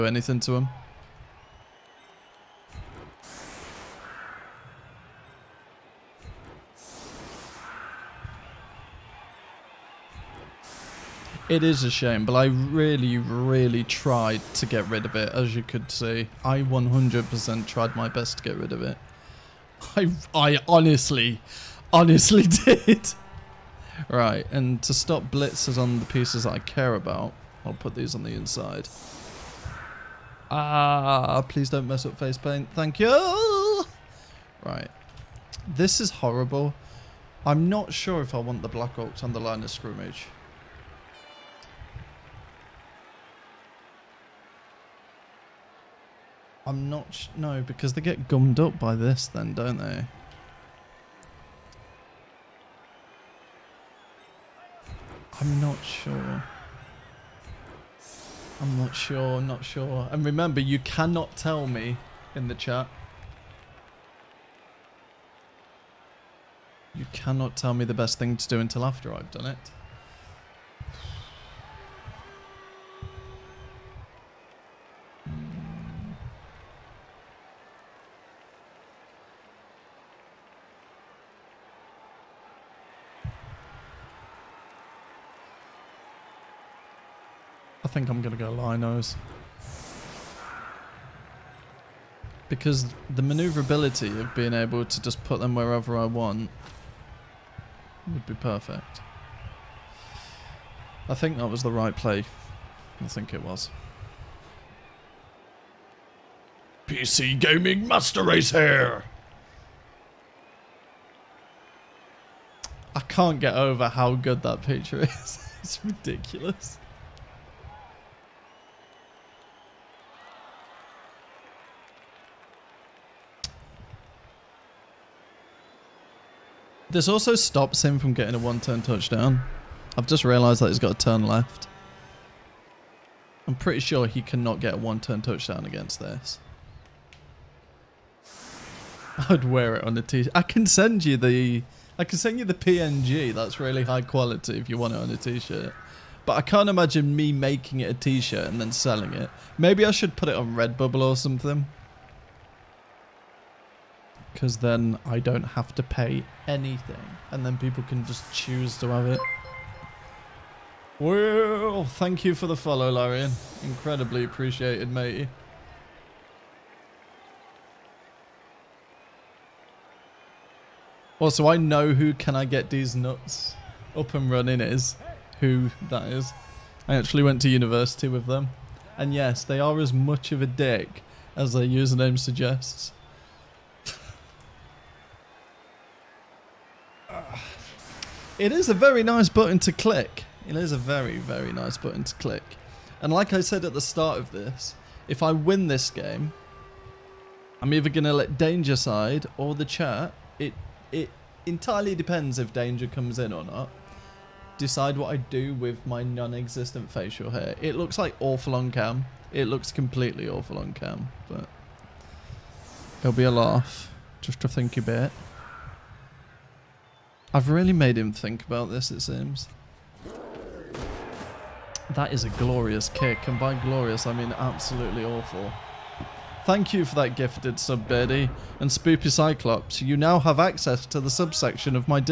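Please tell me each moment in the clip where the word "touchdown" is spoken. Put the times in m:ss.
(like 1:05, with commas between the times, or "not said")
2:08, 2:15.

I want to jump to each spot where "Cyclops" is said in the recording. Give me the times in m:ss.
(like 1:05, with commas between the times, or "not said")
3:49.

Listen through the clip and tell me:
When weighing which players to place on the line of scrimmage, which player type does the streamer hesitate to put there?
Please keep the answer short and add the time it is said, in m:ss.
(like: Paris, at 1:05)
Black Orcs, at 0:38.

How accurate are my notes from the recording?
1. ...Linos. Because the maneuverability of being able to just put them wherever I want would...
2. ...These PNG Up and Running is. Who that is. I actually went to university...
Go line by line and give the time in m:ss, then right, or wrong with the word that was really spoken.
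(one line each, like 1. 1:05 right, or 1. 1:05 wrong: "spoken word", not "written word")
1. 1:28 right
2. 2:52 wrong: "Nuts", not "PNG".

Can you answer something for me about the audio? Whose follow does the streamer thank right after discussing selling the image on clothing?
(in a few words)
Larian.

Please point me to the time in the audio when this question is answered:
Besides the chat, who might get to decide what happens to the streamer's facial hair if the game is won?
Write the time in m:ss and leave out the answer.
3:18.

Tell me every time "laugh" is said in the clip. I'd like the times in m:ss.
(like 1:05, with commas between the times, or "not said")
3:33.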